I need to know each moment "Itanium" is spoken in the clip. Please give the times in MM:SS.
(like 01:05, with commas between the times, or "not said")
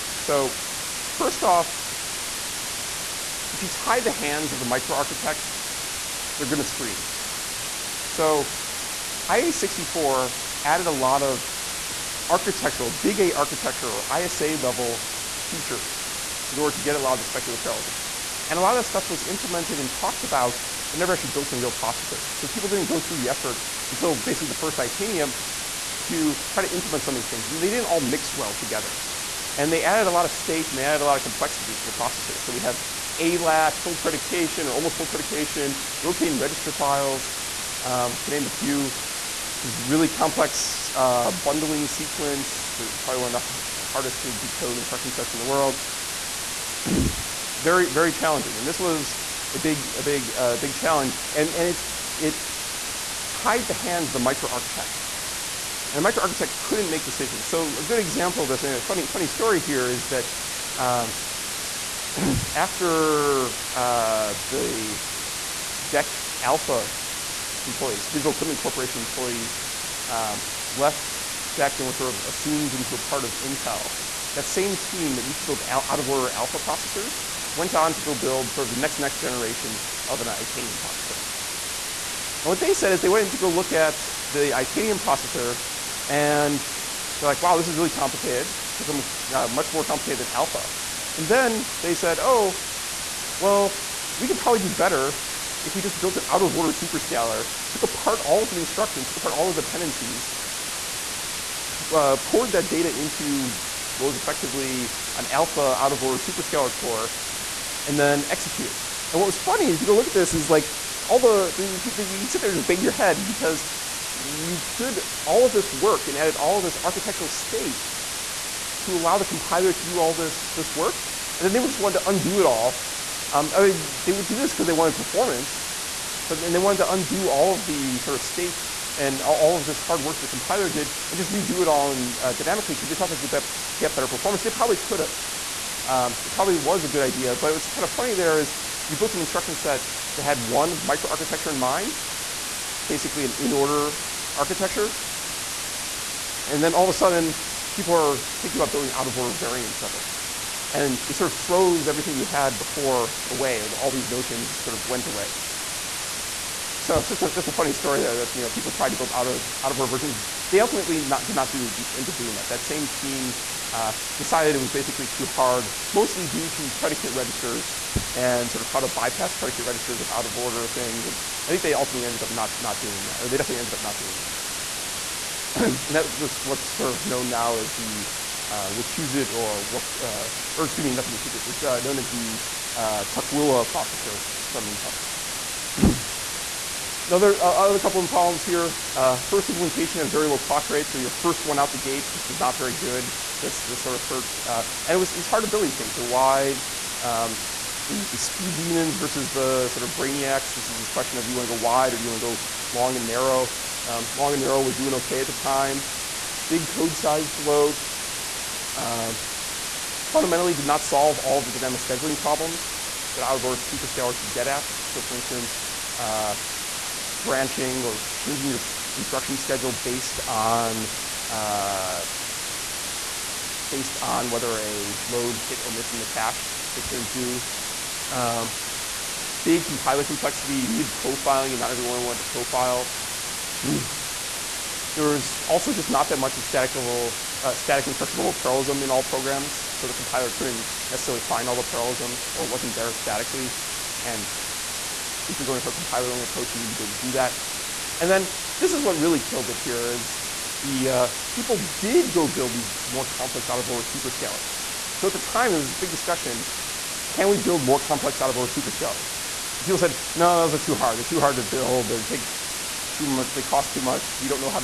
00:24, 01:20, 01:24.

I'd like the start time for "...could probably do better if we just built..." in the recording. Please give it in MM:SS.
01:34.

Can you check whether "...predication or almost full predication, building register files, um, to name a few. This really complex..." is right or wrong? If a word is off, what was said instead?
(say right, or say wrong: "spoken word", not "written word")
wrong: "rotating", not "building".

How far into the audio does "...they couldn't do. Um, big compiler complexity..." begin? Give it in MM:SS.
03:46.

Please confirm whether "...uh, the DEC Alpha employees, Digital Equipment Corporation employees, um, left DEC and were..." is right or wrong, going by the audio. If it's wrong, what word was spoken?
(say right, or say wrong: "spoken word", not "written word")
right.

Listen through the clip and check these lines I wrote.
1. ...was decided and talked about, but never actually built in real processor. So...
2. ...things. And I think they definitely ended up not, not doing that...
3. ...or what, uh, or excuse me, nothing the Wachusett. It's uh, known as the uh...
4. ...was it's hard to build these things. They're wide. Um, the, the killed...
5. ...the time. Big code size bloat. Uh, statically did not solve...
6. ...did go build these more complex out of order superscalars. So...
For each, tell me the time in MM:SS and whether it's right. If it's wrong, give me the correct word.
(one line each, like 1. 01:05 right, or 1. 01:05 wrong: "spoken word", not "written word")
1. 00:19 wrong: "implemented", not "decided"
2. 02:50 wrong: "ultimately", not "definitely"
3. 02:59 right
4. 03:14 wrong: "speed", not "killed"
5. 03:25 wrong: "fundamentally", not "statically"
6. 04:11 right.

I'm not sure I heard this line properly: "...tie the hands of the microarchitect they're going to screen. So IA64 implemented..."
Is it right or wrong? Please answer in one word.
wrong.